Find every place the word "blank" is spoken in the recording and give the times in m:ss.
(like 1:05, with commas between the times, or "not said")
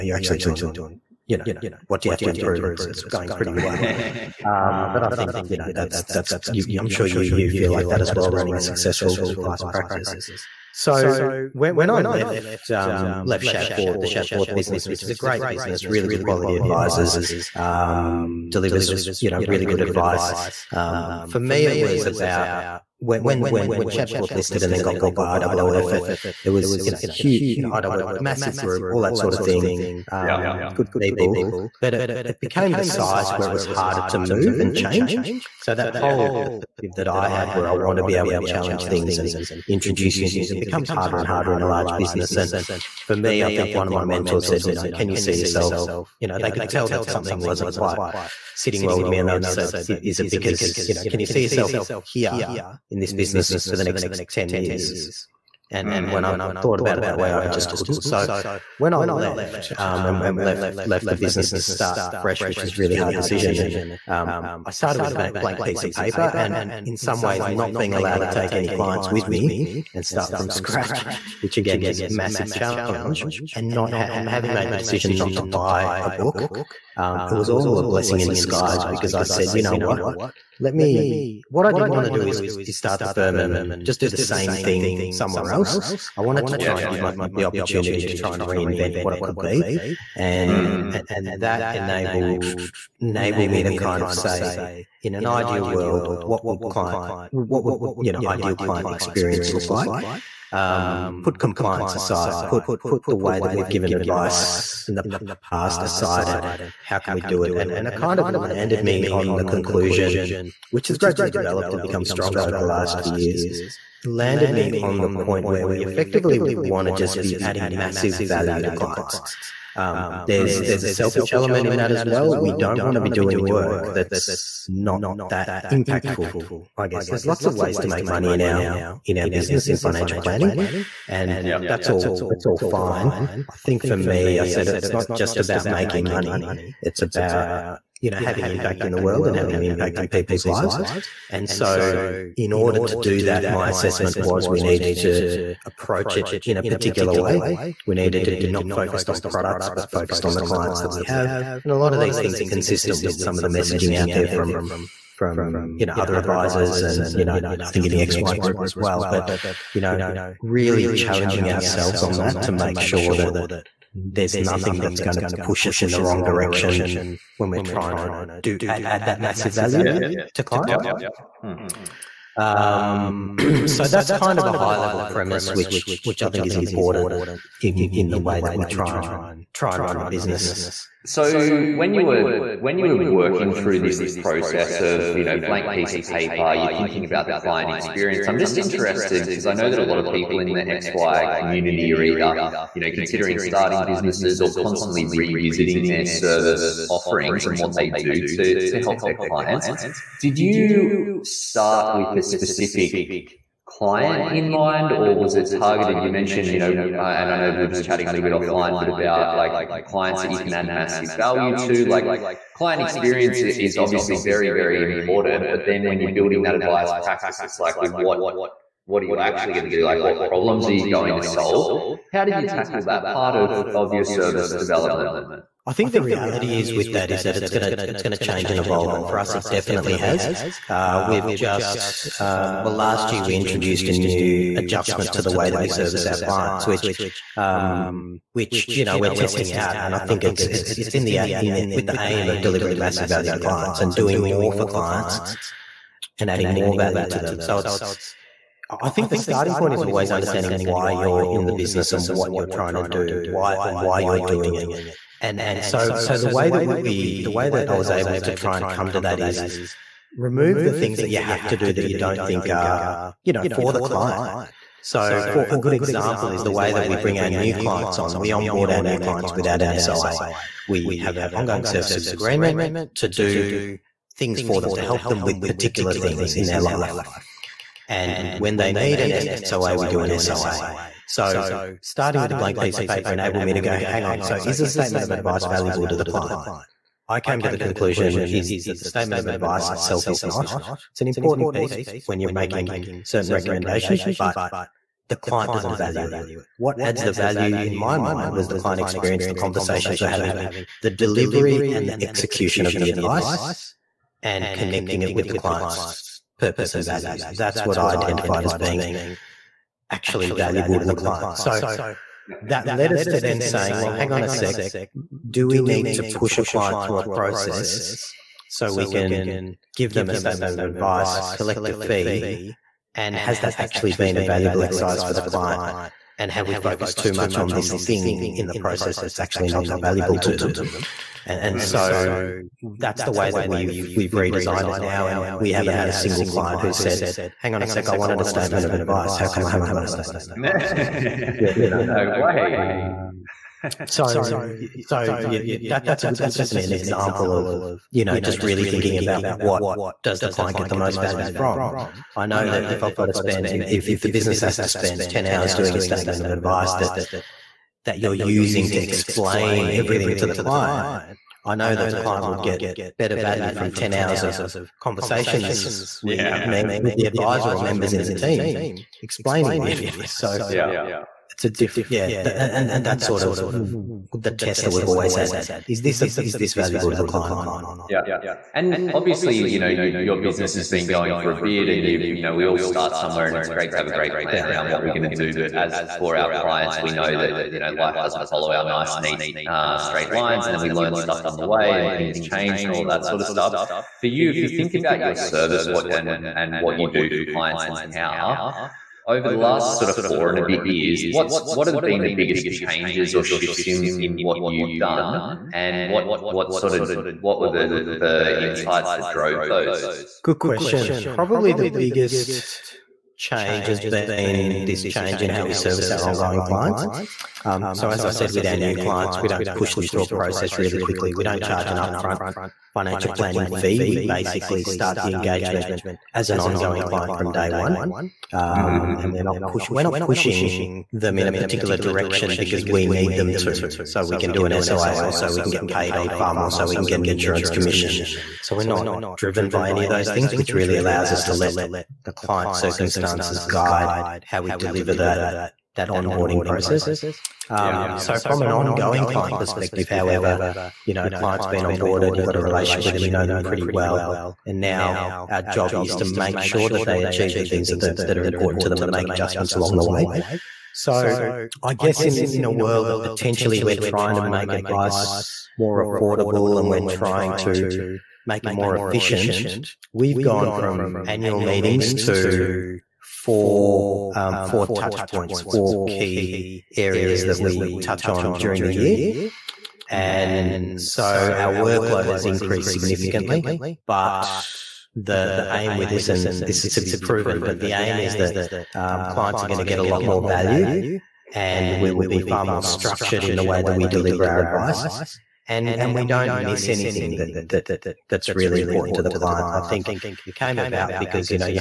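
1:05, 3:05, 4:42.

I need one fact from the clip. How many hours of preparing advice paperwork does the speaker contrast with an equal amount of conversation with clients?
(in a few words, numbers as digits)
10.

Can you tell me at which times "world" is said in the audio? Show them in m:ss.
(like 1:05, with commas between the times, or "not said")
1:35, 2:18, 7:42.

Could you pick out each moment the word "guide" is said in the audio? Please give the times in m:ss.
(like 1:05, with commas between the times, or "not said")
7:23.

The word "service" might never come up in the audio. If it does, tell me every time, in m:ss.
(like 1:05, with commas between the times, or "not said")
3:16, 3:44, 3:55, 4:31, 6:35, 6:55.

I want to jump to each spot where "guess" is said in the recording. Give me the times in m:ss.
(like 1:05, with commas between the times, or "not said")
2:06, 7:41.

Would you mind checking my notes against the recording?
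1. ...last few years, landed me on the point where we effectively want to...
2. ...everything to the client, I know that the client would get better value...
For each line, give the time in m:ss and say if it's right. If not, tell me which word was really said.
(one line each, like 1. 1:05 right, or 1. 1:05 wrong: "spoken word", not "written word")
1. 1:52 right
2. 5:59 right.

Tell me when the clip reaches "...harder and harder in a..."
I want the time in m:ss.
0:40.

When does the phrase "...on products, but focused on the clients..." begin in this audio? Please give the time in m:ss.
2:29.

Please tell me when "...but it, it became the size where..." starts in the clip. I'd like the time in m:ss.
0:31.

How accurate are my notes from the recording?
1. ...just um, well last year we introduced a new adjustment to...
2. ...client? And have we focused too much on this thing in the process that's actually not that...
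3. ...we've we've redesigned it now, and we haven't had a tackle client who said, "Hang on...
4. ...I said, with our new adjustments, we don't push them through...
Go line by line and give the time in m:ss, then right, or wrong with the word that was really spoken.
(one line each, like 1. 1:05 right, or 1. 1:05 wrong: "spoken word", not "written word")
1. 3:51 right
2. 5:25 right
3. 5:33 wrong: "single", not "tackle"
4. 6:58 wrong: "clients", not "adjustments".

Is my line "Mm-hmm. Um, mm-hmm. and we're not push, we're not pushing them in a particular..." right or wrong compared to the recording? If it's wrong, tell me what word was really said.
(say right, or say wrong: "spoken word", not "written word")
right.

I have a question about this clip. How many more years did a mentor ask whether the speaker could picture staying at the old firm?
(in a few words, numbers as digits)
10.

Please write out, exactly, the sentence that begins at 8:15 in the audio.
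And, and we don't miss anything that, that that's really important to the client.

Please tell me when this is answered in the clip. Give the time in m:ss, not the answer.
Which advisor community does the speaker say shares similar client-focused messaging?
2:37.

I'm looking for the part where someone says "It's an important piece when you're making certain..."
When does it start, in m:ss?
4:50.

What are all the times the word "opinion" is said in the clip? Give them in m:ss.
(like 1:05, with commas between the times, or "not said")
not said.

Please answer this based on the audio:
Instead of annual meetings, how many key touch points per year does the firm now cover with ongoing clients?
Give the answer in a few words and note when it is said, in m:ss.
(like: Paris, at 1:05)
4, at 7:54.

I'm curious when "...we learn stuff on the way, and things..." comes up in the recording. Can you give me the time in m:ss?
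6:30.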